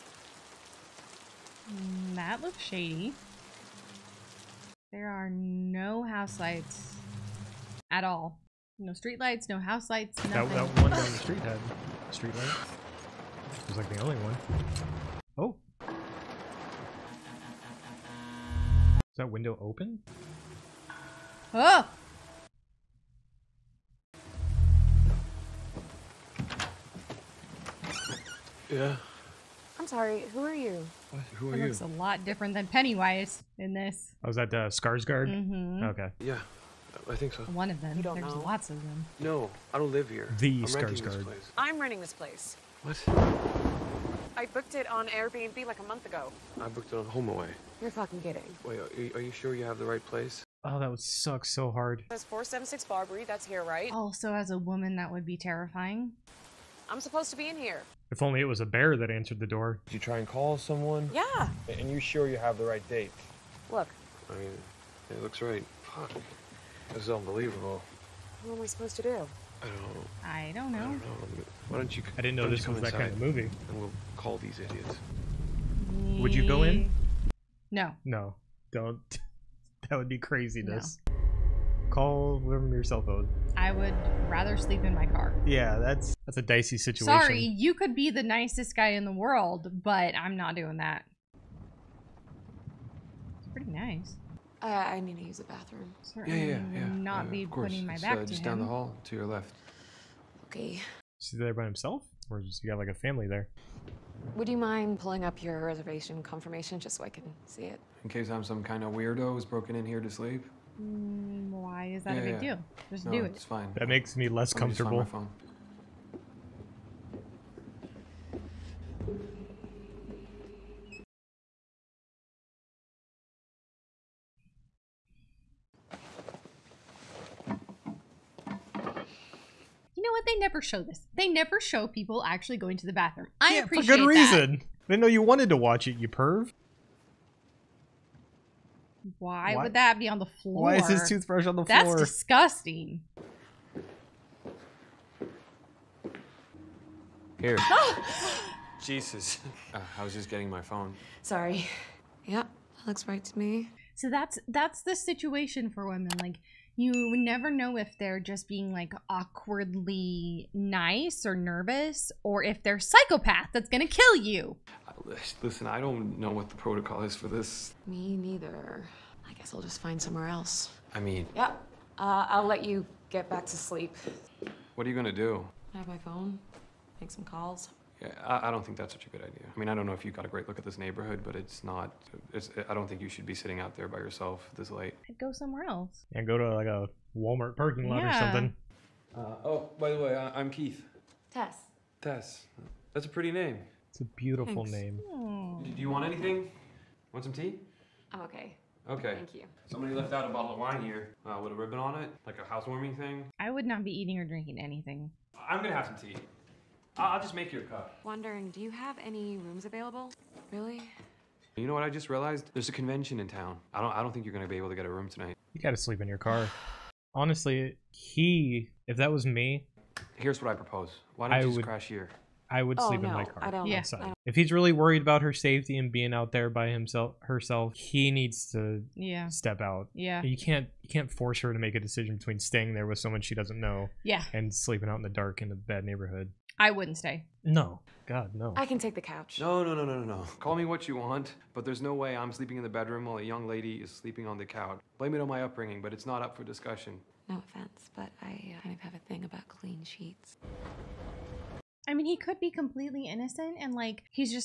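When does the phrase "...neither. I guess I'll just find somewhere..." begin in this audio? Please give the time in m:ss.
2:48.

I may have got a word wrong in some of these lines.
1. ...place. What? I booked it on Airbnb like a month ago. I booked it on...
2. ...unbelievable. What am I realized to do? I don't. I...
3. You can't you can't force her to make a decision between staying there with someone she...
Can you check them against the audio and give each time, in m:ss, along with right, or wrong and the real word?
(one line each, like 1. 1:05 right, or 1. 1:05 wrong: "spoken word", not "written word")
1. 0:42 right
2. 1:07 wrong: "supposed", not "realized"
3. 3:50 right.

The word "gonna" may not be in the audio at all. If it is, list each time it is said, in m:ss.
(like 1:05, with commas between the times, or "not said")
2:43, 2:54, 3:25, 3:34.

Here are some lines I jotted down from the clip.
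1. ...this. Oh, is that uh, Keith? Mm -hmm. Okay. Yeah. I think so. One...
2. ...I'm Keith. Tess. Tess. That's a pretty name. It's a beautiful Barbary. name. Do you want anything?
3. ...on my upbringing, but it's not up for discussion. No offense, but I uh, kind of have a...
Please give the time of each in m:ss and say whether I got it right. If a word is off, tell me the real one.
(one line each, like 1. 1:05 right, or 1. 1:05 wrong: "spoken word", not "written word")
1. 0:33 wrong: "Skarsgård", not "Keith"
2. 3:10 wrong: "Thanks", not "Barbary"
3. 4:05 right.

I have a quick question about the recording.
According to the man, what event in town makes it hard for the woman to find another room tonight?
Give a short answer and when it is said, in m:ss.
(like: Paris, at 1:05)
A convention, at 3:32.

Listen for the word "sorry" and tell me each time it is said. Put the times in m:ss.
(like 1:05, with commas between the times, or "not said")
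0:29, 1:27, 2:31.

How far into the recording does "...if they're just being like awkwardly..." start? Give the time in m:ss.
2:37.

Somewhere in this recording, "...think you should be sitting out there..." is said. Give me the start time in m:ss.
3:02.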